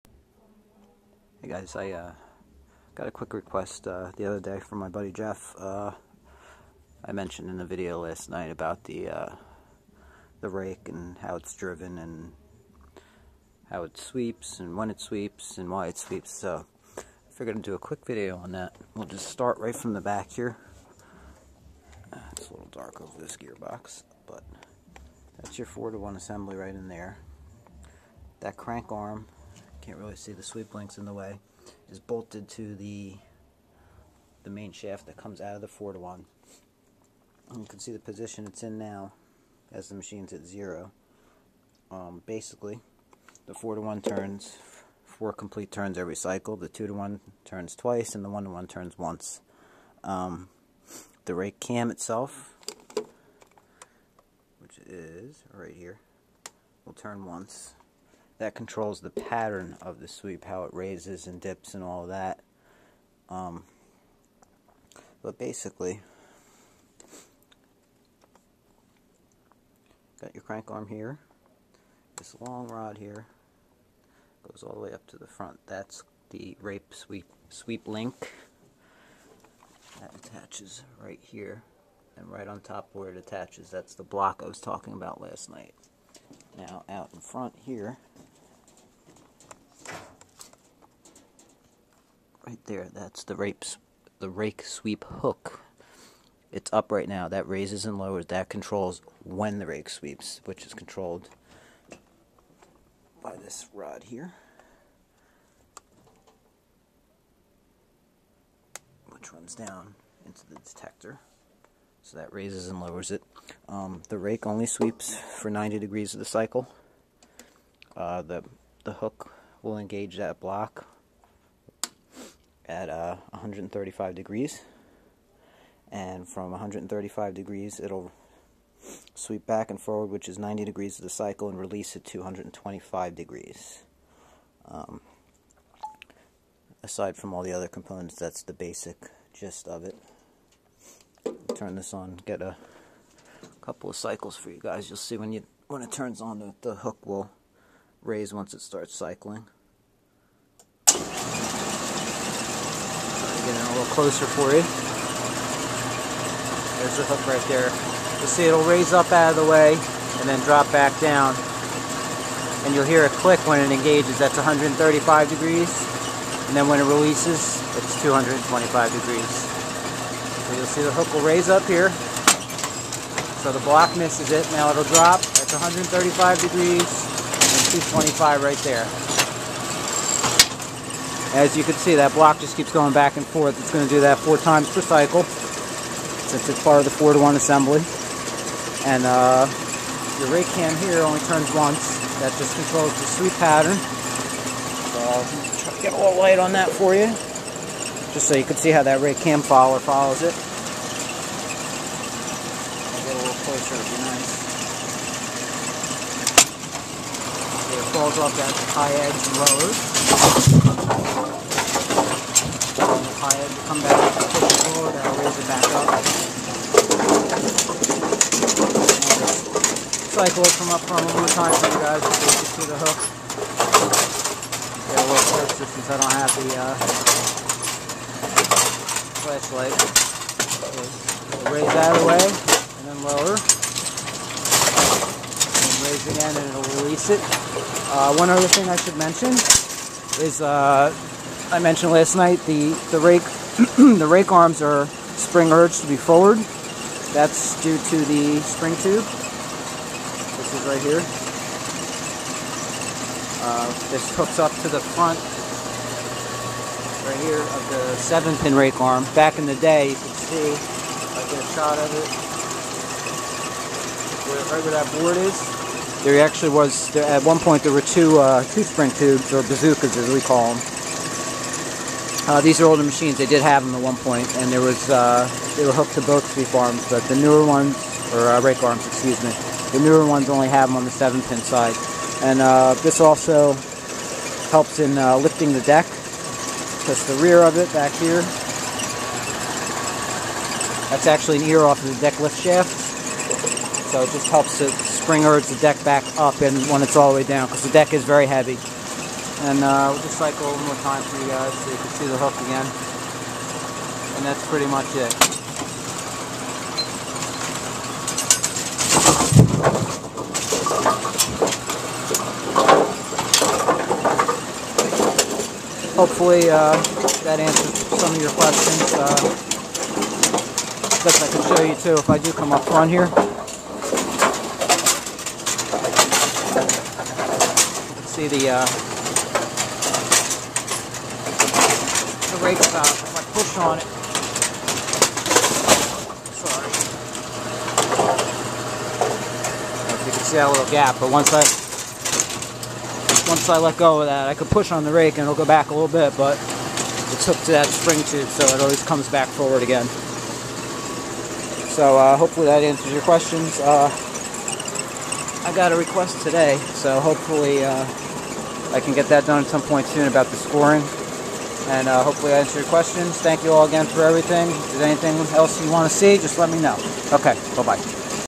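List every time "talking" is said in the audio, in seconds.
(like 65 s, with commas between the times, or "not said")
84 s.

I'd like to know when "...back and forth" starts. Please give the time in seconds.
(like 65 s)
182 s.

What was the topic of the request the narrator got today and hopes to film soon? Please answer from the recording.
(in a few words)
scoring.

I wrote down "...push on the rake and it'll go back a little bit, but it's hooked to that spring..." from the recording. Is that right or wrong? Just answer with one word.
right.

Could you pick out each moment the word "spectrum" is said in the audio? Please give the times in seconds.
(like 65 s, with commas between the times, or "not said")
not said.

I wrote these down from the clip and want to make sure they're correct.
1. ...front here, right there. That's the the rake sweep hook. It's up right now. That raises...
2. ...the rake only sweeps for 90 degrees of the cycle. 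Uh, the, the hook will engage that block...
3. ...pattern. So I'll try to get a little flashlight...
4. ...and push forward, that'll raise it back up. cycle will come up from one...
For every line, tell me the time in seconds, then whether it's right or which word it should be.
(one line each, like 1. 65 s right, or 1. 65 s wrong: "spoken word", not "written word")
1. 87 s right
2. 114 s right
3. 193 s wrong: "light", not "flashlight"
4. 213 s right.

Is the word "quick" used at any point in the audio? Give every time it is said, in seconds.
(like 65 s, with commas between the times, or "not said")
3 s, 17 s.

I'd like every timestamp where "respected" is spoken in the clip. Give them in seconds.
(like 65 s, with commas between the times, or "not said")
not said.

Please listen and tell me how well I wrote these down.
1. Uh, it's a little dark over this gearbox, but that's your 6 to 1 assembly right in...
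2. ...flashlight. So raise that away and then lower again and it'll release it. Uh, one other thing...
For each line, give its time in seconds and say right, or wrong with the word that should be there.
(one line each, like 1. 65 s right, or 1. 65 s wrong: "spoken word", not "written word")
1. 22 s wrong: "4", not "6"
2. 229 s right.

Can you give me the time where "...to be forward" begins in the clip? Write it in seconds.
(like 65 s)
245 s.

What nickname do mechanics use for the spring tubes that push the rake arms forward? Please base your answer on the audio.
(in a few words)
bazookas.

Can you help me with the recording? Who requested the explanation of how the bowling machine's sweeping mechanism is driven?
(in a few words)
Jeff.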